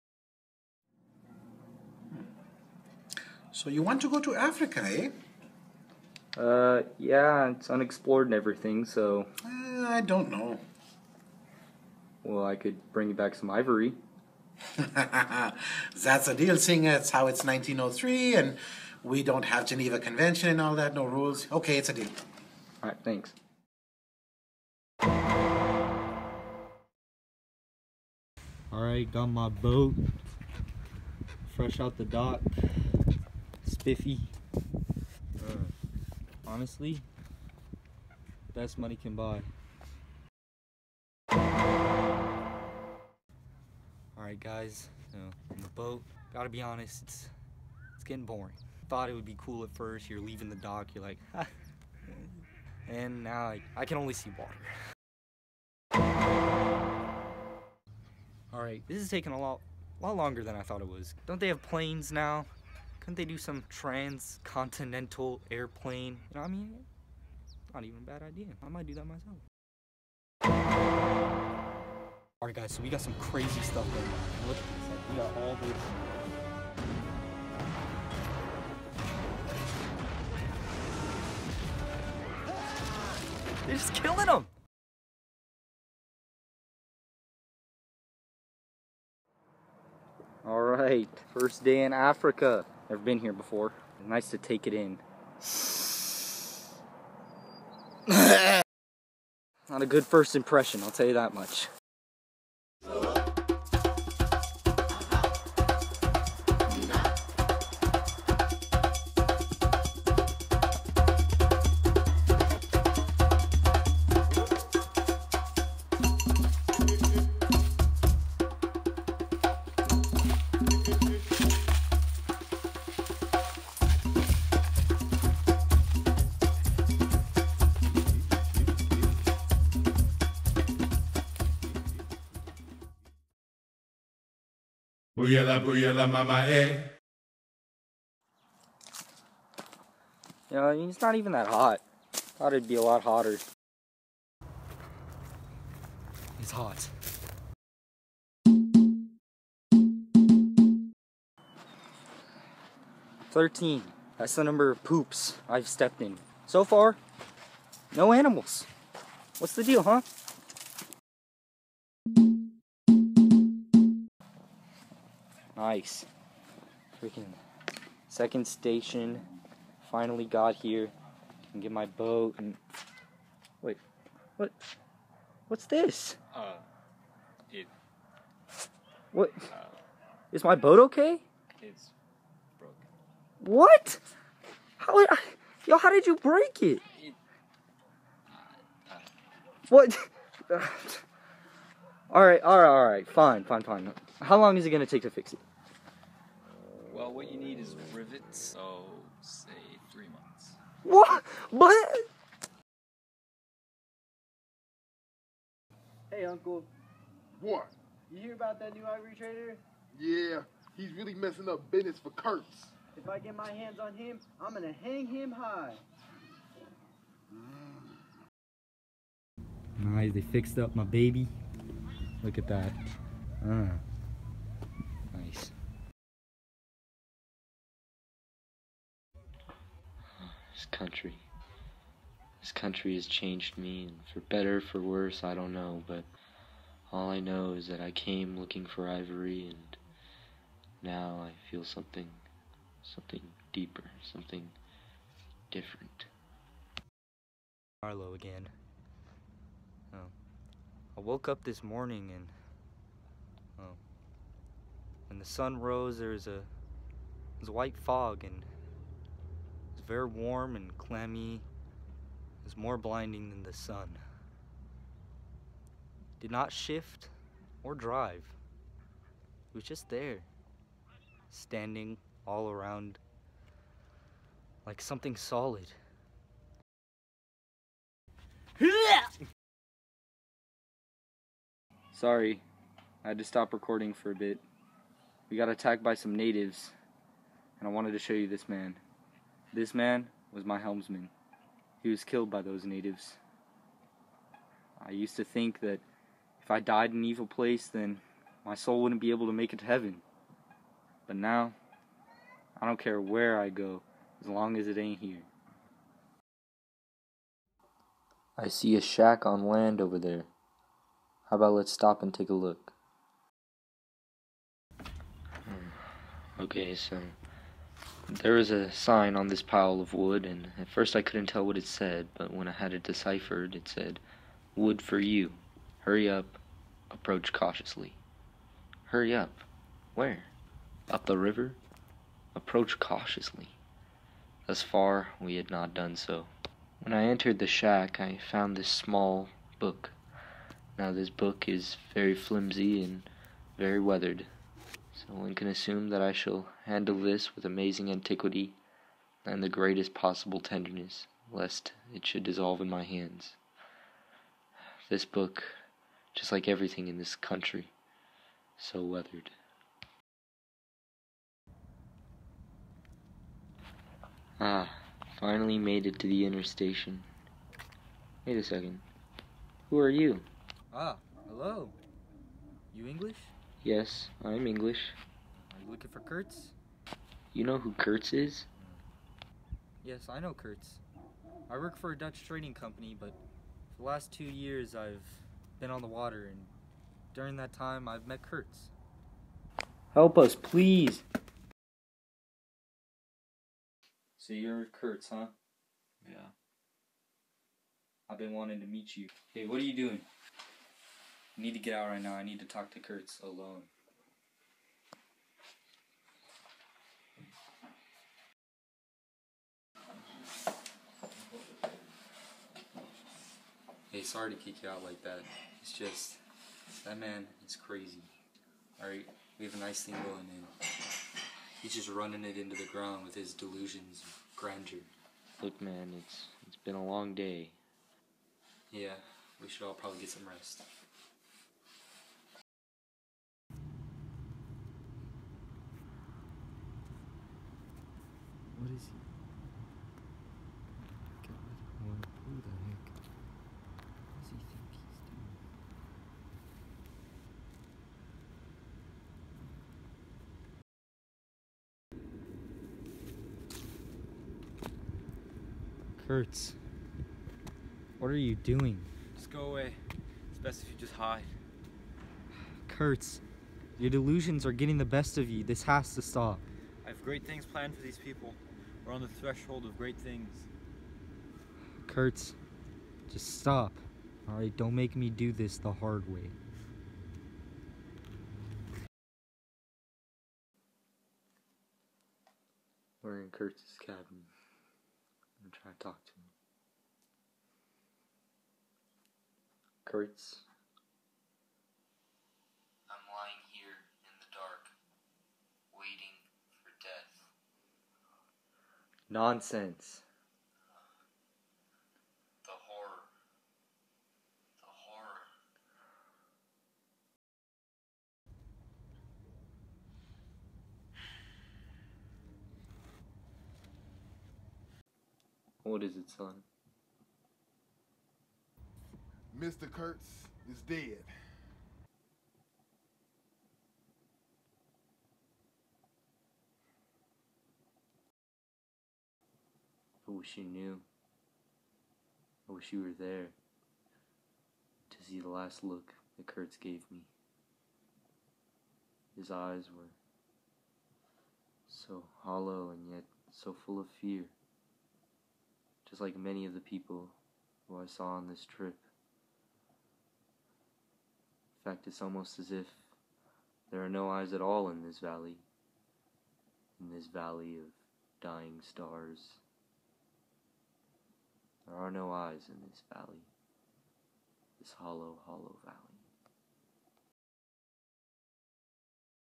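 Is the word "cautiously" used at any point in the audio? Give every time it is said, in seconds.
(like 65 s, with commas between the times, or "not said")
327 s, 332 s.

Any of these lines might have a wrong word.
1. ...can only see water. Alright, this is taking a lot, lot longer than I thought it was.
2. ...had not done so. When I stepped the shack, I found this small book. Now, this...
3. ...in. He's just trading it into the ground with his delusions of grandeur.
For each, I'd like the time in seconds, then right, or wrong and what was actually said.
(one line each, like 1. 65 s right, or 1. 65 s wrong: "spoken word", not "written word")
1. 53 s right
2. 335 s wrong: "entered", not "stepped"
3. 420 s wrong: "running", not "trading".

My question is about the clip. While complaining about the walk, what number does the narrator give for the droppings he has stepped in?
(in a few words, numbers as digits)
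13.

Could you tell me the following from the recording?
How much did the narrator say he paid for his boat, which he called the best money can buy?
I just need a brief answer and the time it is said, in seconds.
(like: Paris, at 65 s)
50, at 33 s.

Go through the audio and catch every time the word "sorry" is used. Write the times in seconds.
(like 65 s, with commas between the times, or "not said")
281 s, 414 s.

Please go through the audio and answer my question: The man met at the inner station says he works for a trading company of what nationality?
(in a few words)
Dutch.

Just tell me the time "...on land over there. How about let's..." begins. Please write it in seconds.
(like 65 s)
309 s.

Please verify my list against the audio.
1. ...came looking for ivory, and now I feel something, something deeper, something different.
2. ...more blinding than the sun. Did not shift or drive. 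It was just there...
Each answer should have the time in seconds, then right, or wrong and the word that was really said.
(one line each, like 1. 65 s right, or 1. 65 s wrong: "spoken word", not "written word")
1. 237 s right
2. 262 s right.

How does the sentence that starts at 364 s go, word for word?
Ah, finally made it to the inner station.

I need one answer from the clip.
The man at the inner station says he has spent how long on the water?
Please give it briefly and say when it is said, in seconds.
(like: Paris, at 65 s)
2 years, at 384 s.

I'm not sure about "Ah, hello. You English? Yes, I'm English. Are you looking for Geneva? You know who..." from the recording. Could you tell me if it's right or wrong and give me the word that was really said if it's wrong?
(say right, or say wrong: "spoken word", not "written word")
wrong: "Kurtz", not "Geneva".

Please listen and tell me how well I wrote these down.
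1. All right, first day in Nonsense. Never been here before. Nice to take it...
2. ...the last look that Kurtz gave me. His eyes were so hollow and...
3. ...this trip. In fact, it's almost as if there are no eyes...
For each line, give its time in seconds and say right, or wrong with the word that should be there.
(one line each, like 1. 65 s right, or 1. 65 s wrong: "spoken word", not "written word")
1. 90 s wrong: "Africa", not "Nonsense"
2. 535 s right
3. 548 s right.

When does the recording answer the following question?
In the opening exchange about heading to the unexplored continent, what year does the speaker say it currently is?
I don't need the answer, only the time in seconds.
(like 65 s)
17 s.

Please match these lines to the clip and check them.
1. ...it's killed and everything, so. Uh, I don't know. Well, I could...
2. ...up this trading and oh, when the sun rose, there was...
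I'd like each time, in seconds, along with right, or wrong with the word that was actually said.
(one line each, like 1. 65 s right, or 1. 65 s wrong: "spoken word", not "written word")
1. 7 s wrong: "unexplored", not "killed"
2. 251 s wrong: "morning", not "trading".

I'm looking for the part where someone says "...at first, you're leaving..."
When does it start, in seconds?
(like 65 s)
49 s.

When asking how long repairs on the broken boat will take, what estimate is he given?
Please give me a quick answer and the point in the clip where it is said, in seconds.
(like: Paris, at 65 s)
3 months, at 199 s.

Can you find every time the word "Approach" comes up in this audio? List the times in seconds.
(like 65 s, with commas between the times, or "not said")
326 s, 332 s.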